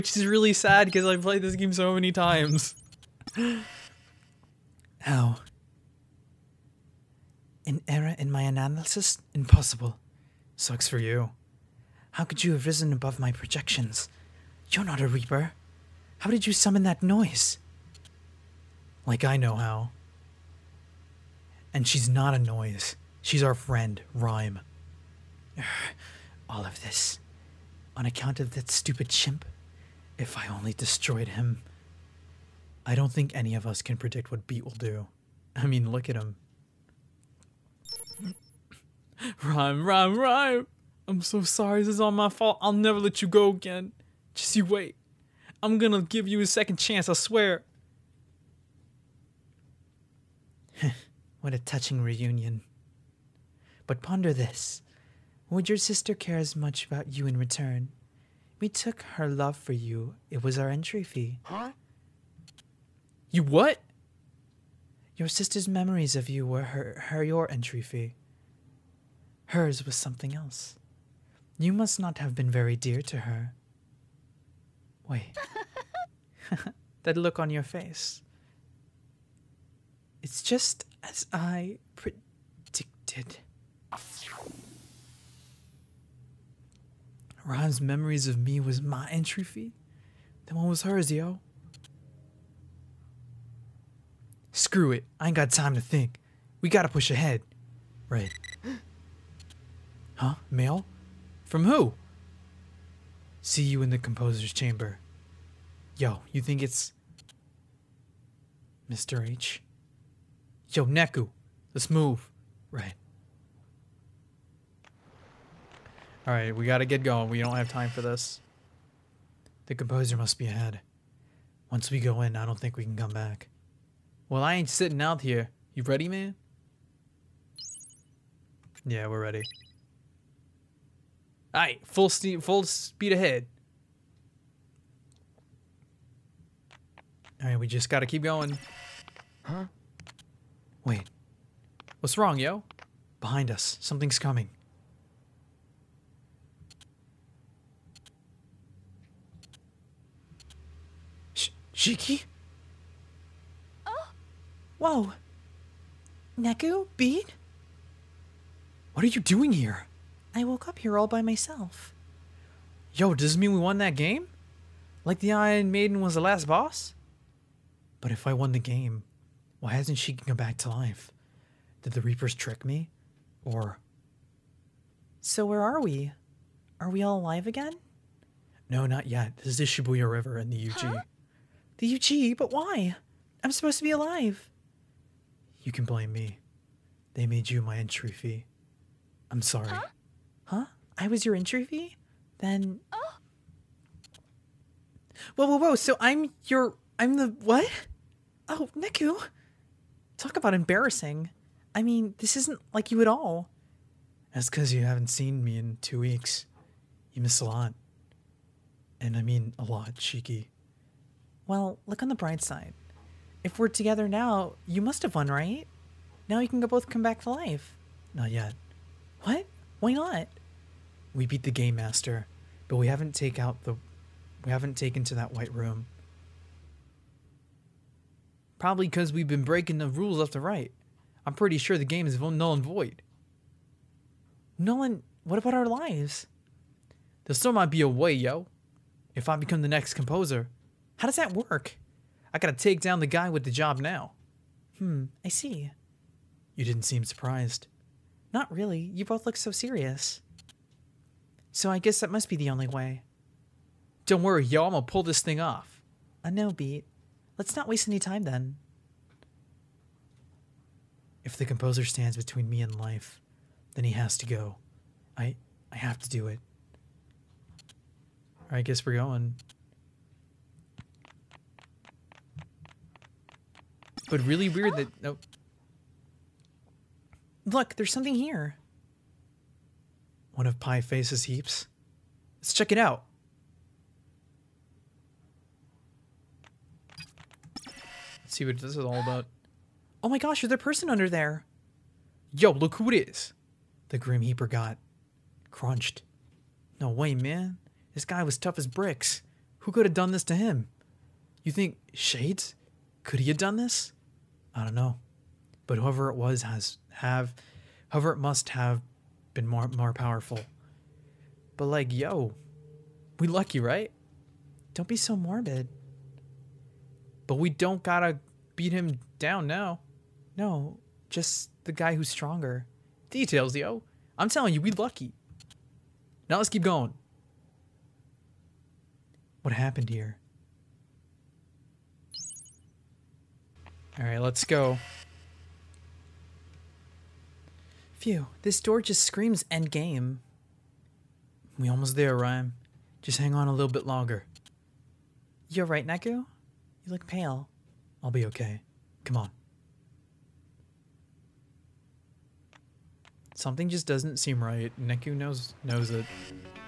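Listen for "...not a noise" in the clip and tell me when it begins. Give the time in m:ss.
0:22.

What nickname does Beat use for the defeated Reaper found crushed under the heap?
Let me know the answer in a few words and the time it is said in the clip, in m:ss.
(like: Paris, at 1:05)
Grim Heaper, at 4:53.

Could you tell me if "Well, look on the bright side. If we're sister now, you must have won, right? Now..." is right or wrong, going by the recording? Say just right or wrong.
wrong.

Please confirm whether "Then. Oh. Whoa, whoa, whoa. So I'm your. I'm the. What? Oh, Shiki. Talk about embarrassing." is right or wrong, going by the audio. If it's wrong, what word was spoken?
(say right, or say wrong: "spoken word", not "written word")
wrong: "Neku", not "Shiki".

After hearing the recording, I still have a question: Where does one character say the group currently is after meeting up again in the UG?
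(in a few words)
Shibuya River.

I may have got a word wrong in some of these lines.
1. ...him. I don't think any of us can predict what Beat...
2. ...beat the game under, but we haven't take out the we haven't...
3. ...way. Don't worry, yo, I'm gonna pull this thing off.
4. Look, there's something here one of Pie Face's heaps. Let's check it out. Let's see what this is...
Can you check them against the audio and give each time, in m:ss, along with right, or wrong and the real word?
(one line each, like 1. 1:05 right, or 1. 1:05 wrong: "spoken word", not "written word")
1. 0:31 right
2. 3:41 wrong: "master", not "under"
3. 4:12 right
4. 4:37 right.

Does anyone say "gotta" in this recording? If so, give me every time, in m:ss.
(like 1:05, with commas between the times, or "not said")
1:36, 1:56, 2:17, 4:02, 5:17.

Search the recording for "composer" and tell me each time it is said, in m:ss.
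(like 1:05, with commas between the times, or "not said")
1:43, 1:59, 3:59, 4:21.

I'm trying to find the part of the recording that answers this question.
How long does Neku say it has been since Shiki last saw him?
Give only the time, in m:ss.
3:25.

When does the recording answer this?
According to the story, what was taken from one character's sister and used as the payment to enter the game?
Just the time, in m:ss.
0:58.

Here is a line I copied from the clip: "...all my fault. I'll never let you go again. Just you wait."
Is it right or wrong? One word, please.
right.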